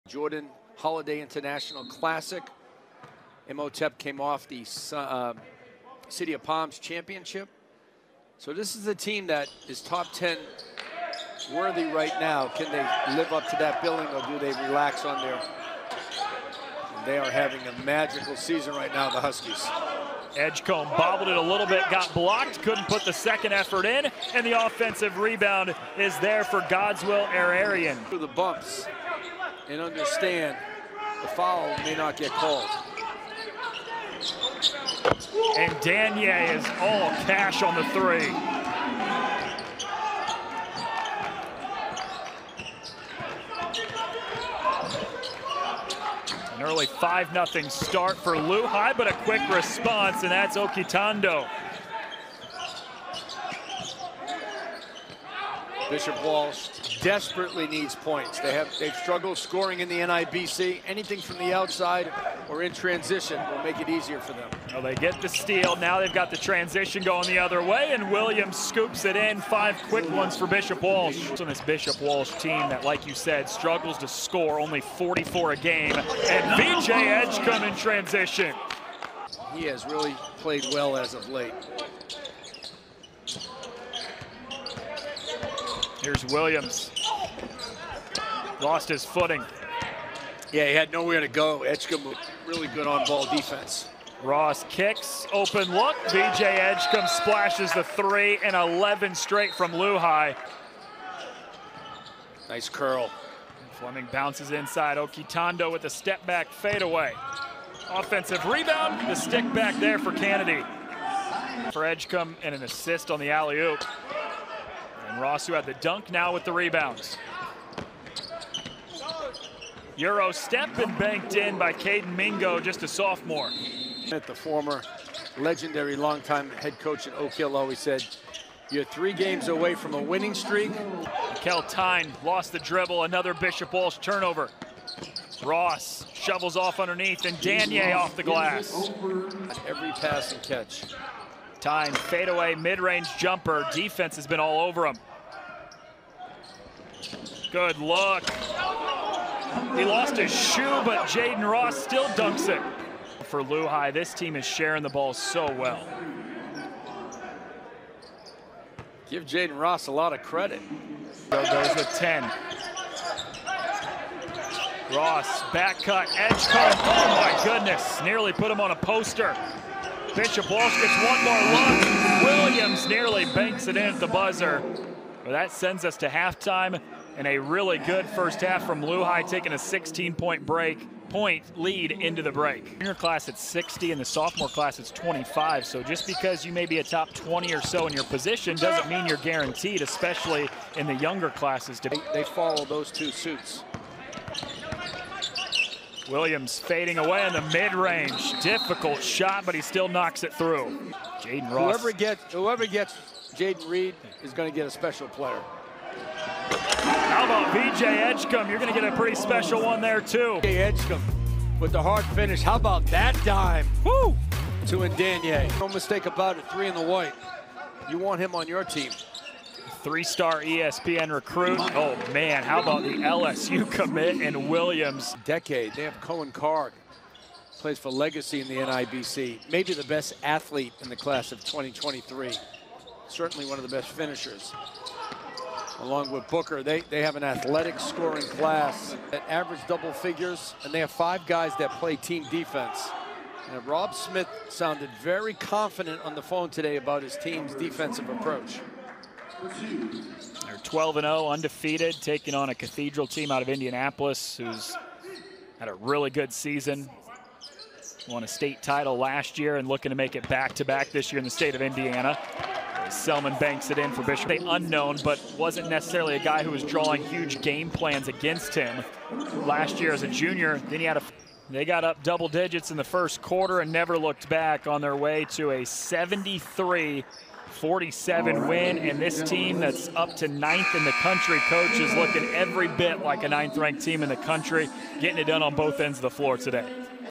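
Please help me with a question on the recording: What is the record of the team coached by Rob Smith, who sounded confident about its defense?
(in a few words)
12 and 0.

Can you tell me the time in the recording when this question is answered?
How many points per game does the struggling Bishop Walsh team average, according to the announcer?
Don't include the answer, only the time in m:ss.
1:14.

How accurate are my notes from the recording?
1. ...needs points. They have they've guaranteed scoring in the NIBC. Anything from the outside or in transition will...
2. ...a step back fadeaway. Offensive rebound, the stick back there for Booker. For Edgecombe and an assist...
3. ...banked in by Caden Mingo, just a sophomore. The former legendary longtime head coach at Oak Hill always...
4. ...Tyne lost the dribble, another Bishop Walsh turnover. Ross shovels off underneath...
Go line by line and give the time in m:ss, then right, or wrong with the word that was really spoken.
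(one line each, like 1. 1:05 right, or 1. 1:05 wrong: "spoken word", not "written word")
1. 0:57 wrong: "struggled", not "guaranteed"
2. 1:45 wrong: "Kennedy", not "Booker"
3. 2:00 right
4. 2:11 right.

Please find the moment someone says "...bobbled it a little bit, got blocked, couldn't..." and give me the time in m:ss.
0:20.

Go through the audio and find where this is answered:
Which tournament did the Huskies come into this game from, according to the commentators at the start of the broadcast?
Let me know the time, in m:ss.
0:06.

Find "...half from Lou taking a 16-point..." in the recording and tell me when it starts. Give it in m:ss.
2:58.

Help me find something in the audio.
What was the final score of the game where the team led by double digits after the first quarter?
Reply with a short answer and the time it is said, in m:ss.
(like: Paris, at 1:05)
73-47, at 4:35.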